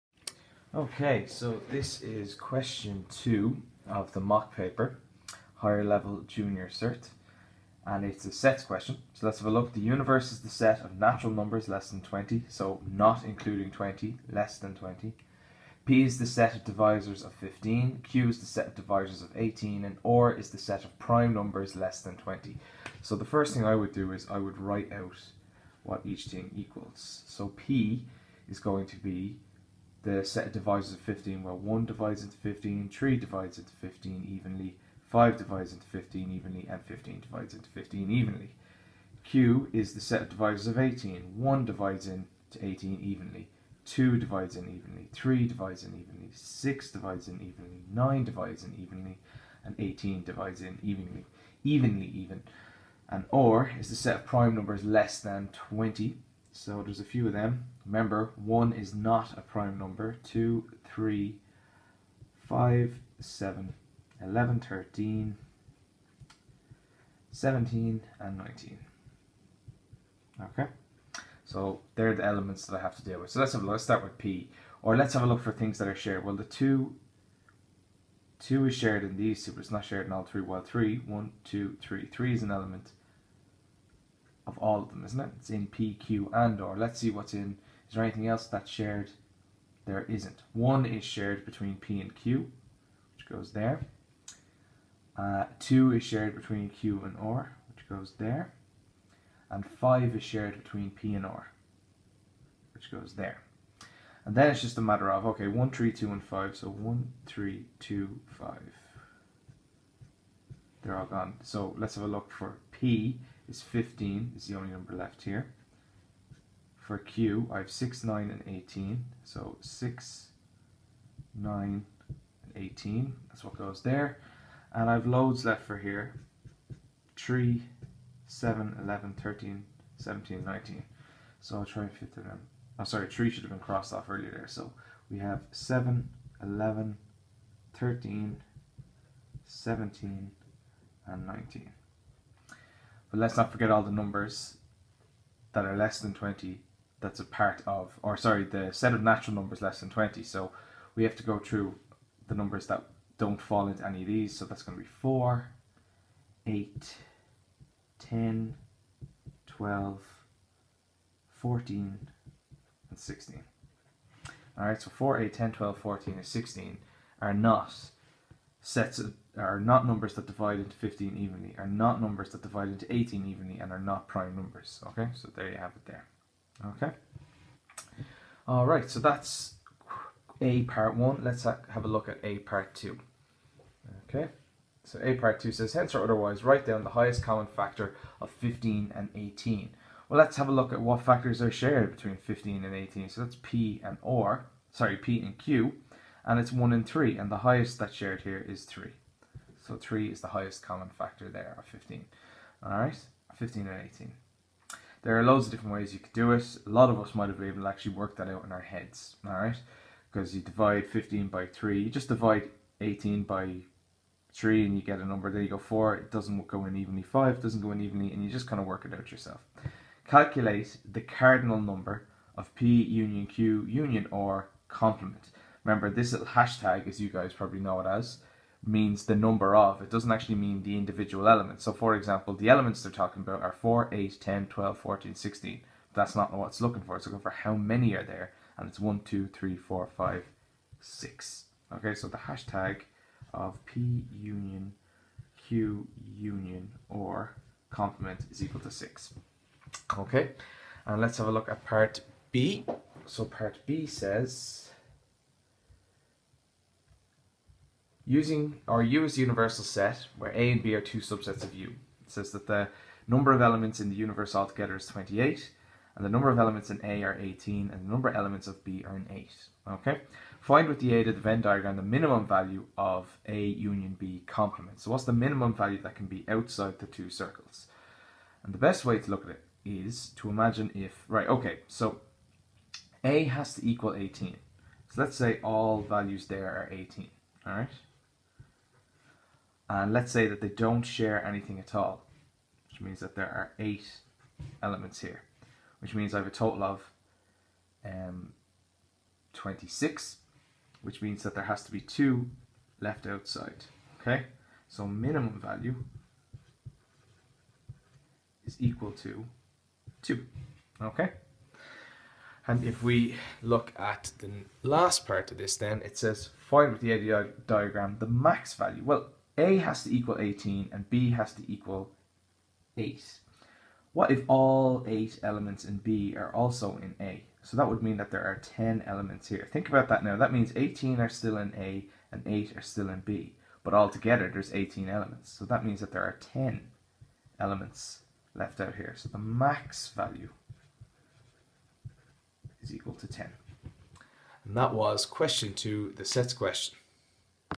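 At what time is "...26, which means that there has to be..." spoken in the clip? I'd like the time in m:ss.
4:59.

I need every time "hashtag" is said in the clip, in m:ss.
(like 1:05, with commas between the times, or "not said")
3:46, 4:02.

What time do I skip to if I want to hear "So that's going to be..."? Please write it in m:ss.
2:34.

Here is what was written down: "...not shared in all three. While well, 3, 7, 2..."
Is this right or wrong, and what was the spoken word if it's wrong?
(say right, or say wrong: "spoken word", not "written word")
wrong: "1", not "7".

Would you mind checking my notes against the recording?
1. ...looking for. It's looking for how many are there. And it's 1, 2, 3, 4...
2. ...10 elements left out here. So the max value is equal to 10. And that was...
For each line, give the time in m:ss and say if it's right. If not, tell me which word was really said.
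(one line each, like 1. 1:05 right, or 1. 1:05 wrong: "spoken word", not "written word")
1. 3:56 right
2. 5:36 right.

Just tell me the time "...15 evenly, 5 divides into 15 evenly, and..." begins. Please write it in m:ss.
0:33.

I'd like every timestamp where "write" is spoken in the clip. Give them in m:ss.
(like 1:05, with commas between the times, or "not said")
0:24, 3:06.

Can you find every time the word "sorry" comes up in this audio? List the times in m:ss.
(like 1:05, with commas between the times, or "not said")
2:12, 2:28, 3:14.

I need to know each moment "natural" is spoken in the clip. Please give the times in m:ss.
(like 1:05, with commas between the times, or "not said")
0:10, 2:29.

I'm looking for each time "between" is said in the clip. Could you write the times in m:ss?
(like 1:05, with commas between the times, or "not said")
1:31, 1:36, 1:40, 3:11.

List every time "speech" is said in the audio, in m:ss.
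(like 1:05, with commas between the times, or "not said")
not said.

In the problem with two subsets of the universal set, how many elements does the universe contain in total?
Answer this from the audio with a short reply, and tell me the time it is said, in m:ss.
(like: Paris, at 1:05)
28, at 4:24.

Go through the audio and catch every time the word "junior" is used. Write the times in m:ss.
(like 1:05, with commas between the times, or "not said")
0:06.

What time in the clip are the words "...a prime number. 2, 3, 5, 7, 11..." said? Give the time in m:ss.
0:59.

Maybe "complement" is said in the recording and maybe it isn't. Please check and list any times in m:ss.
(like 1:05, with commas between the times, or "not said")
3:44, 4:07, 4:34.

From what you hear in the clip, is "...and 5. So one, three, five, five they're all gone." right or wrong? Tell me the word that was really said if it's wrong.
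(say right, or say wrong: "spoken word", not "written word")
wrong: "two", not "five".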